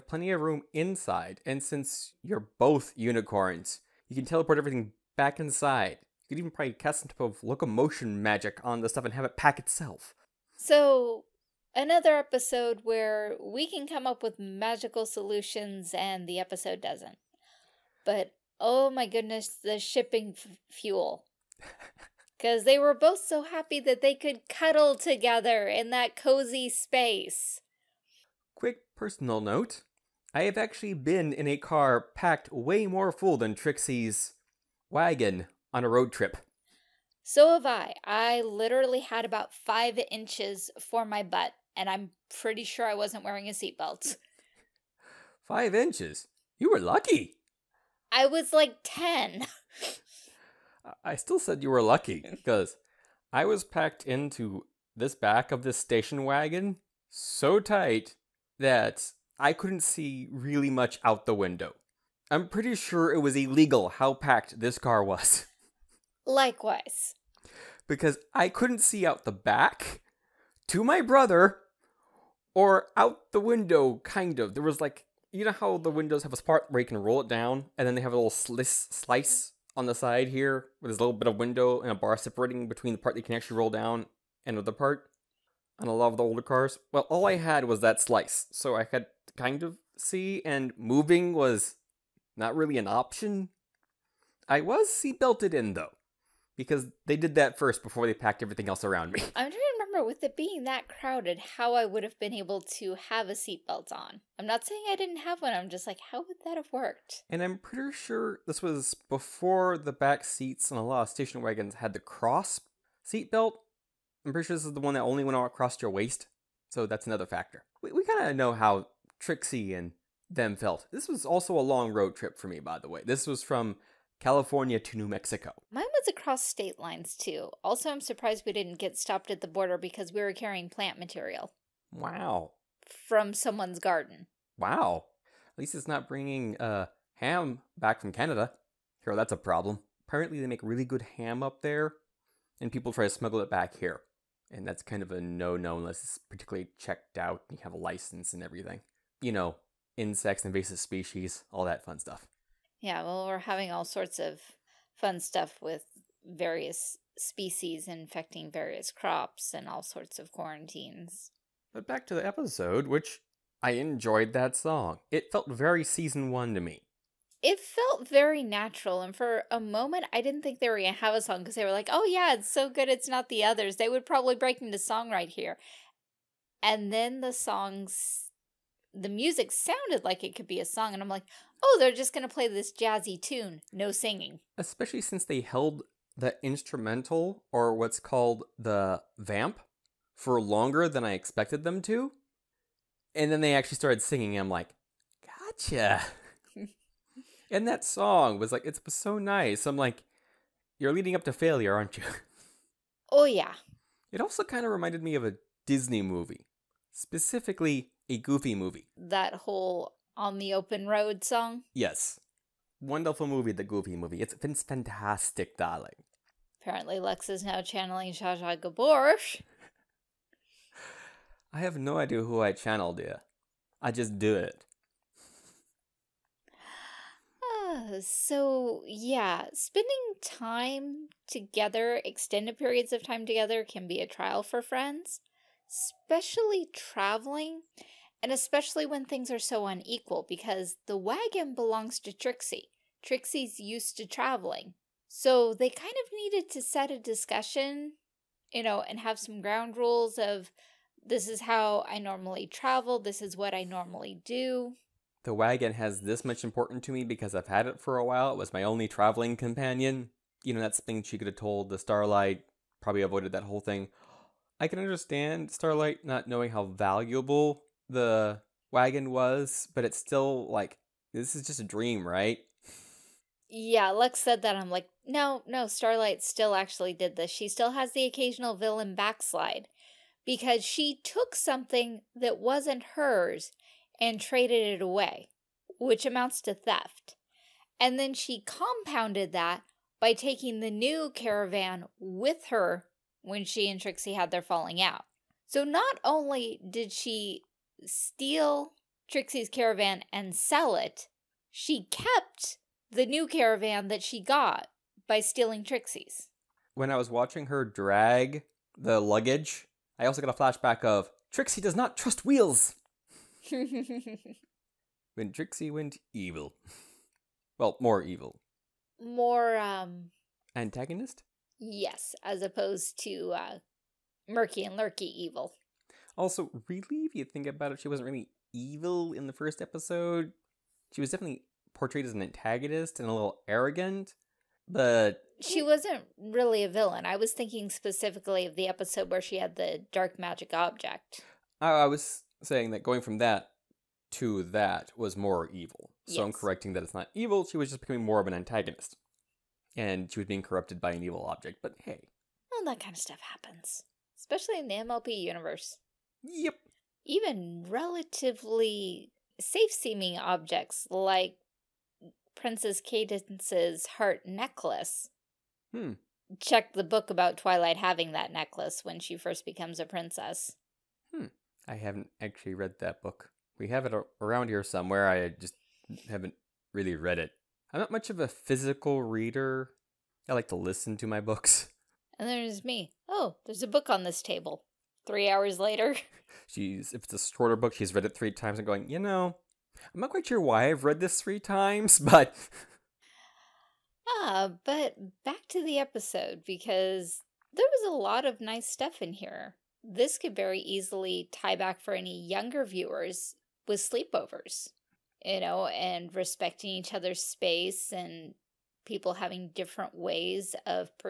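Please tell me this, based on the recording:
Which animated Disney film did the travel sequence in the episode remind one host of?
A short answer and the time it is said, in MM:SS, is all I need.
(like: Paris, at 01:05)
A Goofy Movie, at 03:28.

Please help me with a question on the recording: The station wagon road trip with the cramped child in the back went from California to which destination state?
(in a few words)
New Mexico.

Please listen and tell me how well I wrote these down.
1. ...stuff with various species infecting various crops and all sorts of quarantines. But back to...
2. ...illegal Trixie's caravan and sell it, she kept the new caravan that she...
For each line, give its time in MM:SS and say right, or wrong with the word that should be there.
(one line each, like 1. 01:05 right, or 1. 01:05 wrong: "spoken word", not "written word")
1. 02:35 right
2. 04:57 wrong: "steal", not "illegal".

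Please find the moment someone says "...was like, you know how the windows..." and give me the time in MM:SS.
01:14.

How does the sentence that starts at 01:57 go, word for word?
We, we kind of know how Trixie and them felt.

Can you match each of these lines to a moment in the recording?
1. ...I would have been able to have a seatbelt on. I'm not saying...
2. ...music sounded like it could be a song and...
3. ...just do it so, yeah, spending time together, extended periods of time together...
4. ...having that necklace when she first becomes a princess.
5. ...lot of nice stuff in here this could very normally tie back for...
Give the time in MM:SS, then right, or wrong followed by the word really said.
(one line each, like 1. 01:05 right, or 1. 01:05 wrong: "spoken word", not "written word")
1. 01:41 right
2. 02:59 right
3. 03:43 right
4. 06:07 right
5. 06:37 wrong: "easily", not "normally".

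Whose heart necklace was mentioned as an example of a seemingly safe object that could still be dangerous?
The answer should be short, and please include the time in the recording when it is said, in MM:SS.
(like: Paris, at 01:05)
Princess Cadance, at 06:02.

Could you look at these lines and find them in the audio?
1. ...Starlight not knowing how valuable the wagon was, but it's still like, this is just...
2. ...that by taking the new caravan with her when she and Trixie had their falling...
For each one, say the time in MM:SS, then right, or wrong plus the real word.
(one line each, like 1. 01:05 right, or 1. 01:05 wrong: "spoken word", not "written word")
1. 04:25 right
2. 04:49 right.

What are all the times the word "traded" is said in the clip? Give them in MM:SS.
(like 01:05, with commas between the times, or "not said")
04:44.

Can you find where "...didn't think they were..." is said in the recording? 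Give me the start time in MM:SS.
02:50.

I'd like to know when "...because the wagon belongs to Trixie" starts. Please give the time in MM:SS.
04:00.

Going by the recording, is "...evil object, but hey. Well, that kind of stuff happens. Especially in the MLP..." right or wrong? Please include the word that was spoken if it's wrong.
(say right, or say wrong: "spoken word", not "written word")
right.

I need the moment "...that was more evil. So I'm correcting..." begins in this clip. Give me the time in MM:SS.
05:44.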